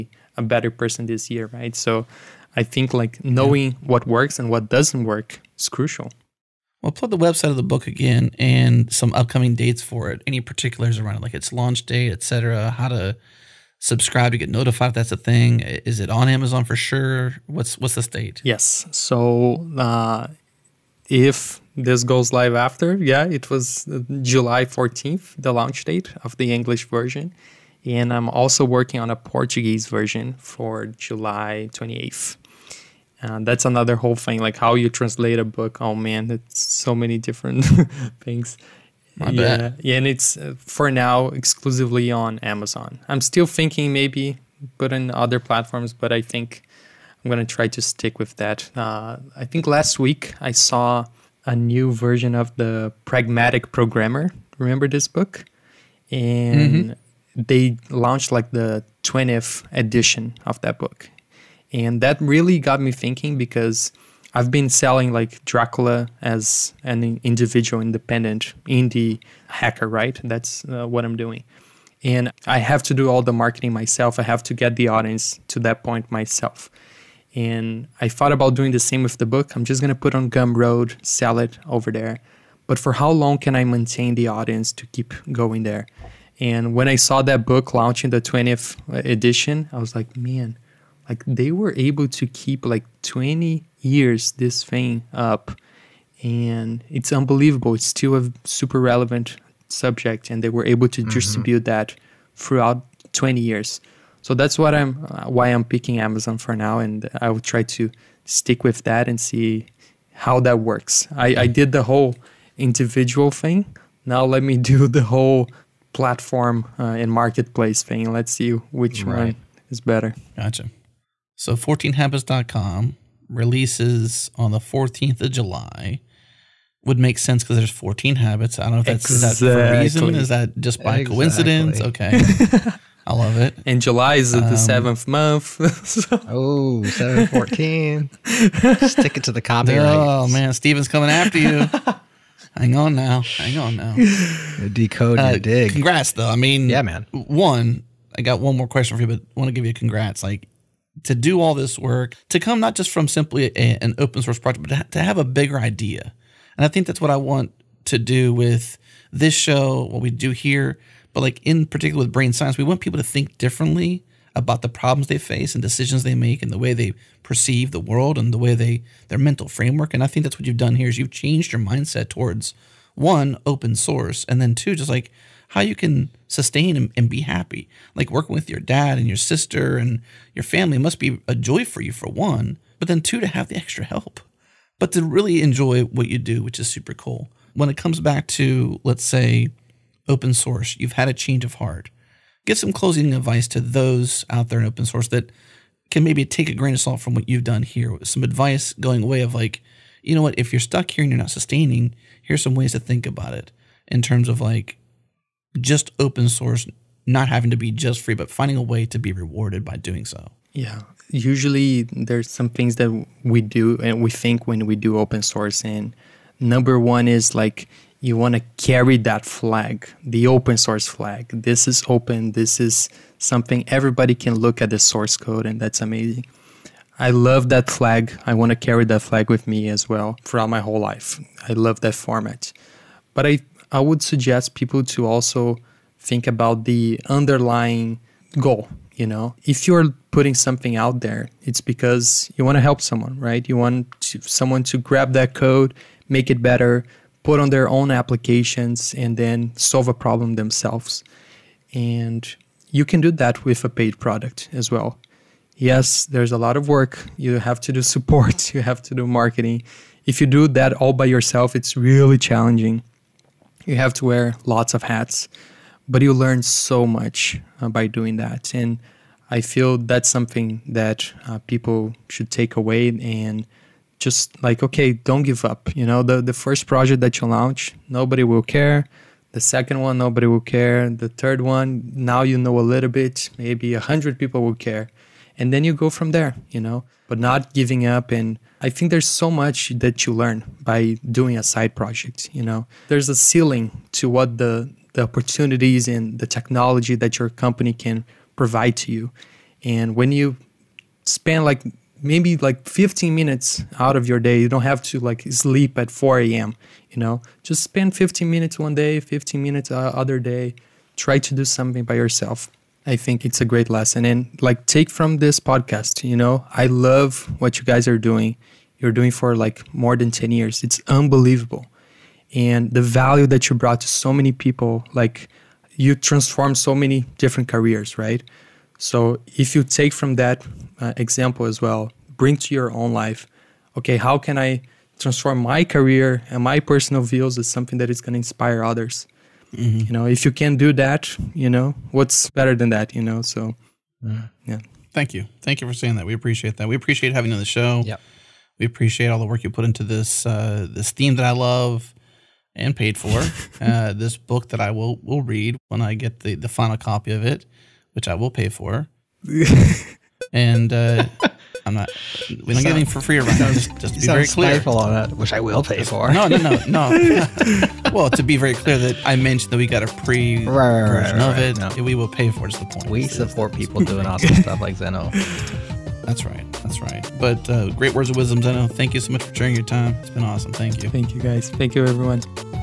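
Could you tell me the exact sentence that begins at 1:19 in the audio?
I'm just going to put on Gumroad, sell it over there.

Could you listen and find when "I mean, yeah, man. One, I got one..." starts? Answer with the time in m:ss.
2:26.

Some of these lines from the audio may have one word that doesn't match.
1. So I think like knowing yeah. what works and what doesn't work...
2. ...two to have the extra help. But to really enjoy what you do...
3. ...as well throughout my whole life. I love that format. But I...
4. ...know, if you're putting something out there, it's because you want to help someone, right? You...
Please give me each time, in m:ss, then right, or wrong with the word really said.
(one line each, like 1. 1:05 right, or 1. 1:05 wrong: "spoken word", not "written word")
1. 0:01 right
2. 3:02 right
3. 3:49 right
4. 3:59 right.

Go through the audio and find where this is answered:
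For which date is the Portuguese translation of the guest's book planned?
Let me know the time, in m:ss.
0:30.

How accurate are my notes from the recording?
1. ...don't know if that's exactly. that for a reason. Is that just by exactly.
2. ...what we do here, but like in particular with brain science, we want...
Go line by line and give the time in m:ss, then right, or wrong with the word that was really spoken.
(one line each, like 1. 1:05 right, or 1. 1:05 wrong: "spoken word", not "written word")
1. 2:08 right
2. 2:39 right.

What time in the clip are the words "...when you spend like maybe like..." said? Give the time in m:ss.
4:59.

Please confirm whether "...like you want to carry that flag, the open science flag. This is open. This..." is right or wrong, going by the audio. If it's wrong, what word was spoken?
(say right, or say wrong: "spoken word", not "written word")
wrong: "source", not "science".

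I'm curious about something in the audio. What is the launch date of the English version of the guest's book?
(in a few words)
July 14th.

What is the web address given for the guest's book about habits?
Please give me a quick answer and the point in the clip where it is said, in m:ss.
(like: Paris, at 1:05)
14habits.com, at 2:01.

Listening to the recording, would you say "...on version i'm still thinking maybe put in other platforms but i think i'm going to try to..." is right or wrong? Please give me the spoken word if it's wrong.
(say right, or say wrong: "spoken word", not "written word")
wrong: "amazon", not "version".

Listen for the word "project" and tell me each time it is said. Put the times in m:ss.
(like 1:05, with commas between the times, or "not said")
2:34, 4:36, 4:51.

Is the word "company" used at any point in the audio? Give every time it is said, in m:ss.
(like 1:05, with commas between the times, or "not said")
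4:57.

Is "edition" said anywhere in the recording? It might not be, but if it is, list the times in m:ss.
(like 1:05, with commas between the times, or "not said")
0:59, 1:29.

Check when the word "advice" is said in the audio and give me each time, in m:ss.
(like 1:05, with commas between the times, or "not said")
3:13, 3:18.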